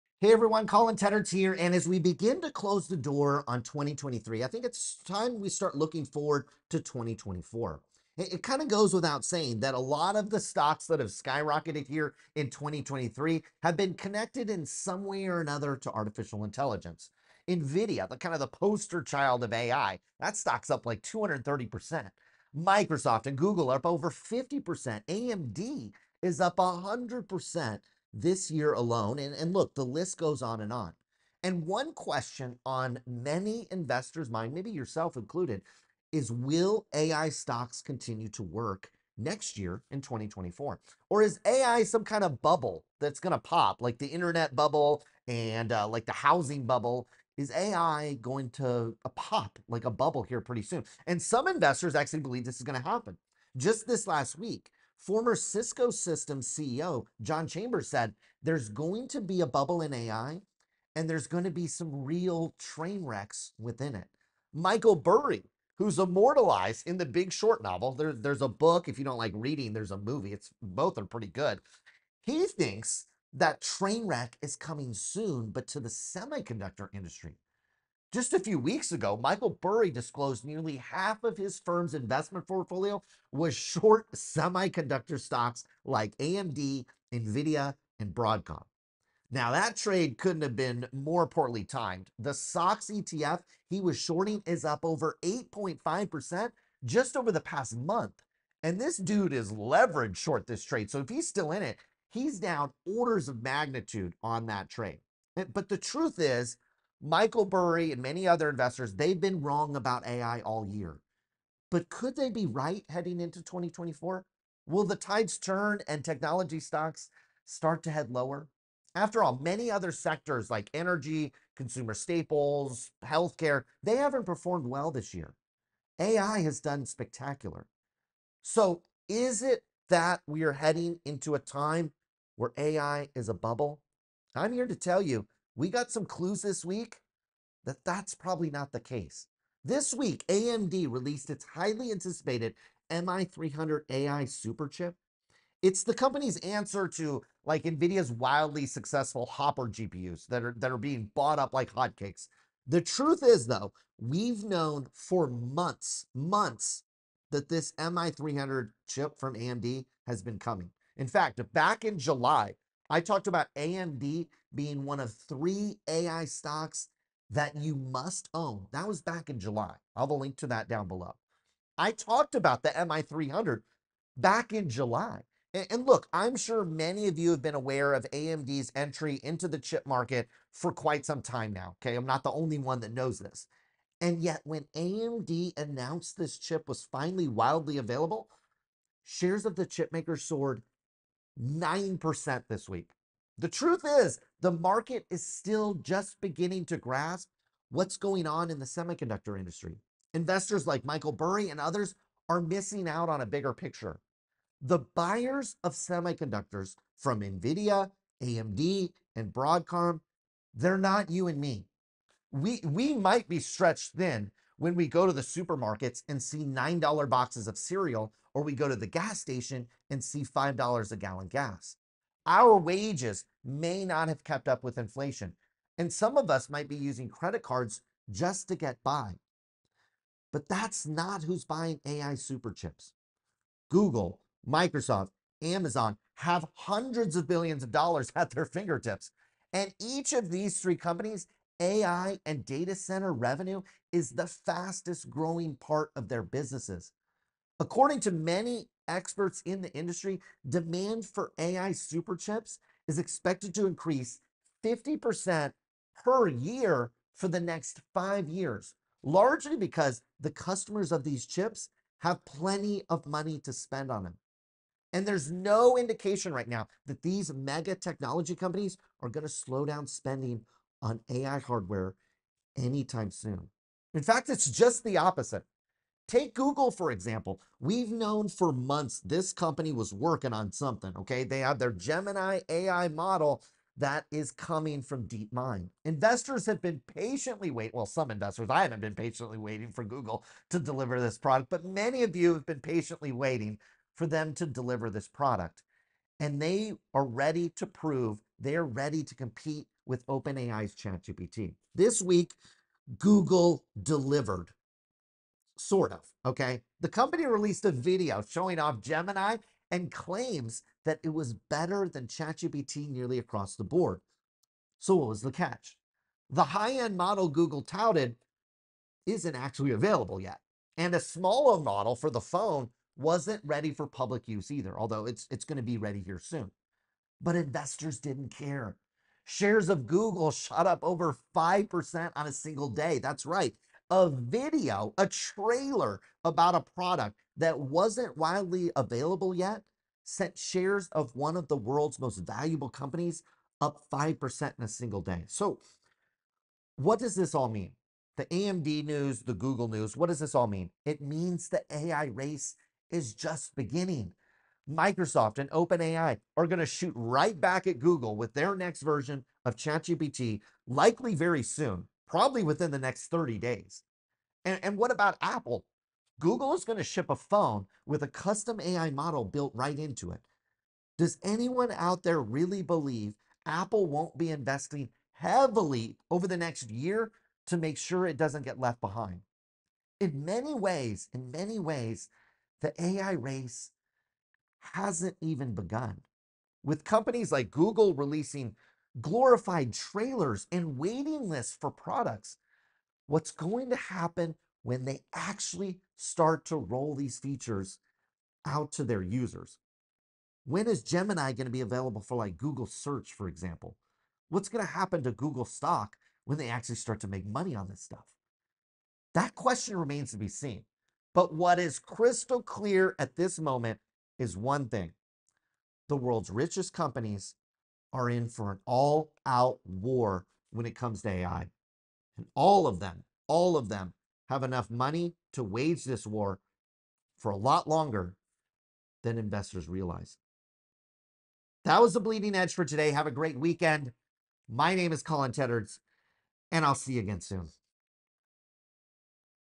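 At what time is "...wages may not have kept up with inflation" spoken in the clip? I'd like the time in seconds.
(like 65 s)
222 s.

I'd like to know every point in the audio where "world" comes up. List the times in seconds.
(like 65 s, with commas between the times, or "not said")
341 s, 415 s.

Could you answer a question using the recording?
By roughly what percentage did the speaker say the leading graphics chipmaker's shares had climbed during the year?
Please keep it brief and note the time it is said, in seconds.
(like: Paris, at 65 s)
230%, at 21 s.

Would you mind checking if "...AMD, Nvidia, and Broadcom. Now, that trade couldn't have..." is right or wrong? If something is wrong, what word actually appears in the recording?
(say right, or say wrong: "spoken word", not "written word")
right.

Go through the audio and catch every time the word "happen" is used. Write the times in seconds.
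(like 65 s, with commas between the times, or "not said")
52 s, 393 s, 404 s.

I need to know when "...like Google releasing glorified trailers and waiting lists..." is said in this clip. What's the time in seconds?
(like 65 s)
387 s.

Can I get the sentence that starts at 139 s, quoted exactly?
This week, AMD released its highly anticipated MI300 AI superchip.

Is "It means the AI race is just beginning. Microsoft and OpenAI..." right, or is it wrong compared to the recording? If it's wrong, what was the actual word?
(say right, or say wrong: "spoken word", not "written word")
right.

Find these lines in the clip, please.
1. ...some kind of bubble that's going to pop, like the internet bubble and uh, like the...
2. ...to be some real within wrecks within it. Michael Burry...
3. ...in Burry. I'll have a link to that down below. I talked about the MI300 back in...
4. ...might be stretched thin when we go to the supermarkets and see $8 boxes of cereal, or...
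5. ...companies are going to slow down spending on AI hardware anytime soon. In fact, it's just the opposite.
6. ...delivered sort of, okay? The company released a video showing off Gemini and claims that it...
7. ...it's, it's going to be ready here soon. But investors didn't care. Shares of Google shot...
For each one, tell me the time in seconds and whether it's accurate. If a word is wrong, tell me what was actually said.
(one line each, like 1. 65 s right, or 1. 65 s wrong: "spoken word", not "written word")
1. 41 s right
2. 61 s wrong: "train", not "within"
3. 169 s wrong: "July", not "Burry"
4. 212 s wrong: "9", not "8"
5. 268 s right
6. 303 s right
7. 325 s right.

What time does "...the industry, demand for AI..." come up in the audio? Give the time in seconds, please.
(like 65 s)
249 s.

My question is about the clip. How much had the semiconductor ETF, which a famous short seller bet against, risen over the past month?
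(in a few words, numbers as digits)
8.5%.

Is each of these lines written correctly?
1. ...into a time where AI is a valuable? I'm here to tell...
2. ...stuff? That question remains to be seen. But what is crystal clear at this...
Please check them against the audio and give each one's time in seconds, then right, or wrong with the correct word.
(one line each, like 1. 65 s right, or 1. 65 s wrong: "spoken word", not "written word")
1. 131 s wrong: "bubble", not "valuable"
2. 407 s right.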